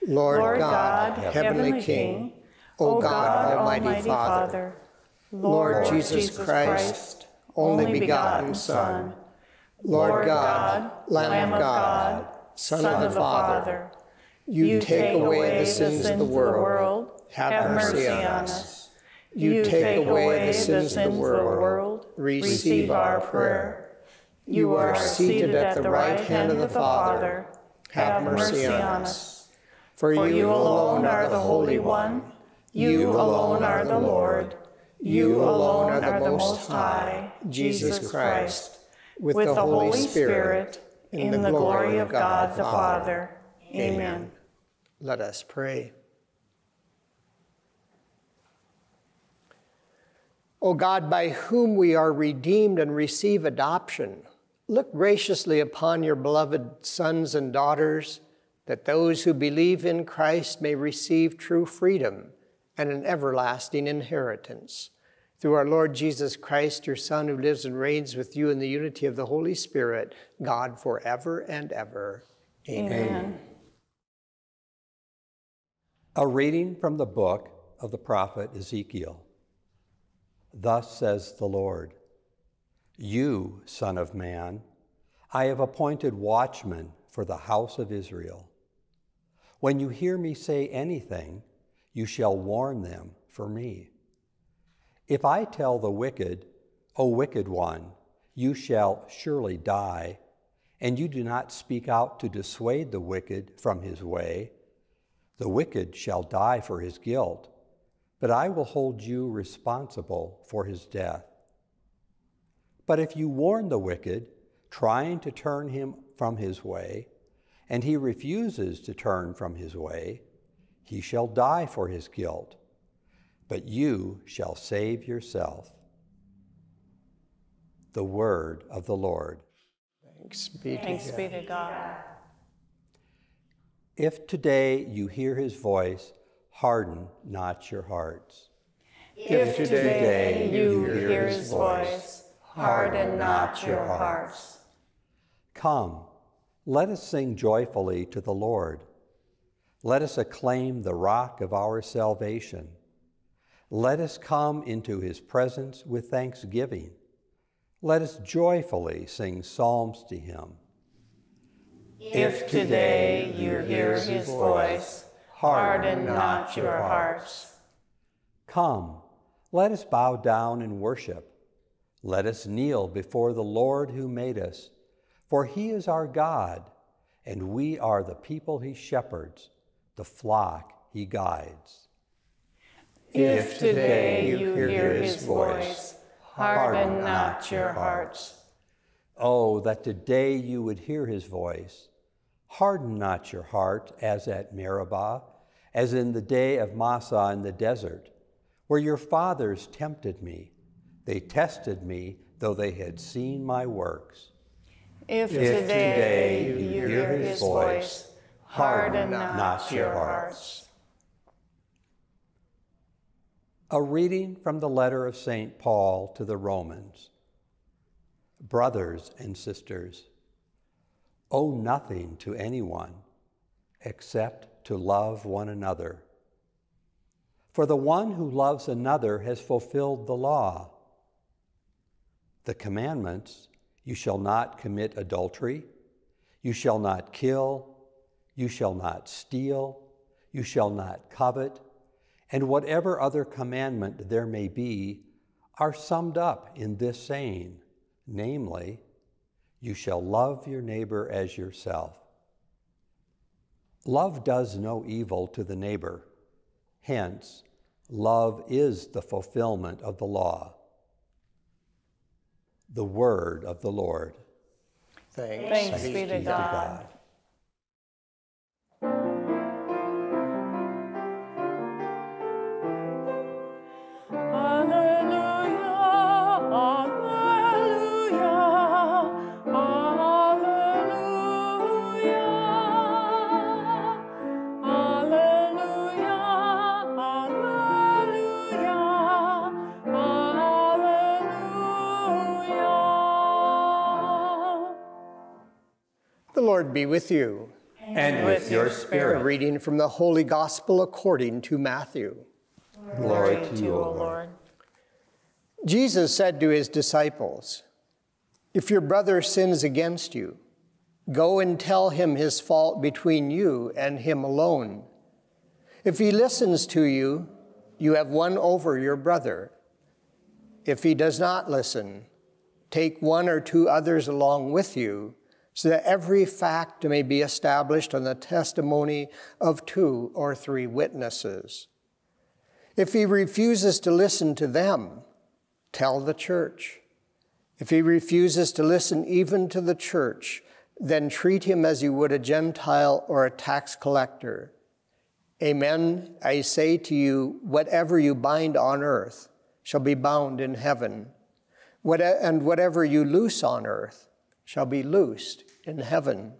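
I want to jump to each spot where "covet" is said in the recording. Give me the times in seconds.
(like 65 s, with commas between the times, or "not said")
241 s.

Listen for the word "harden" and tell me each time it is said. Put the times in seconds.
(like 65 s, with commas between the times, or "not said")
136 s, 142 s, 165 s, 186 s, 192 s, 208 s.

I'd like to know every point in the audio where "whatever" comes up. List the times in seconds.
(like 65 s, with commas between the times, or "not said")
242 s, 347 s, 352 s.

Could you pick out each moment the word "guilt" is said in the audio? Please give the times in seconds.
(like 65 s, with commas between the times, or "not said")
106 s, 122 s.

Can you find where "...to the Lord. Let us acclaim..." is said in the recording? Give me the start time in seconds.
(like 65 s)
148 s.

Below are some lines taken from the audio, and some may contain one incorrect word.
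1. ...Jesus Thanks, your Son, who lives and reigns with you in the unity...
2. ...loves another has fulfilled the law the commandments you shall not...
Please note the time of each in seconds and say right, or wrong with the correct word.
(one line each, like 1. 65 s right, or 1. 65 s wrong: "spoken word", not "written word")
1. 65 s wrong: "Christ", not "Thanks"
2. 228 s right.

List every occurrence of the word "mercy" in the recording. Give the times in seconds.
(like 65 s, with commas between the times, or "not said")
17 s, 28 s.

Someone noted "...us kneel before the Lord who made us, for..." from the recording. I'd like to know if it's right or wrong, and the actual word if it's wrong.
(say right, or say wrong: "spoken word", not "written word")
right.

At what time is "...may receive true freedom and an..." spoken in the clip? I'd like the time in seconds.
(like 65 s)
60 s.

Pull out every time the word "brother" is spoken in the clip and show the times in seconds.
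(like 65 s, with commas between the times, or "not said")
218 s, 308 s, 318 s.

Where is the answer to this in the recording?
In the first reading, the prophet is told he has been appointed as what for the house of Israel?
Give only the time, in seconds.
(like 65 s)
86 s.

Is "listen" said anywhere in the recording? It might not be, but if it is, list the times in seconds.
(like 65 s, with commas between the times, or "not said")
316 s, 321 s, 333 s, 338 s.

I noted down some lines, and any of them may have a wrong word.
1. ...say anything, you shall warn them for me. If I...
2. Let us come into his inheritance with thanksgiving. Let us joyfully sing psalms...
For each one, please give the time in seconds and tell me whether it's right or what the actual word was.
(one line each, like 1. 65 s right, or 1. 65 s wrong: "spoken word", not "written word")
1. 90 s right
2. 153 s wrong: "presence", not "inheritance".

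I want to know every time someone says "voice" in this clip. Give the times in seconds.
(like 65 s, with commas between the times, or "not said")
135 s, 141 s, 164 s, 185 s, 191 s, 207 s.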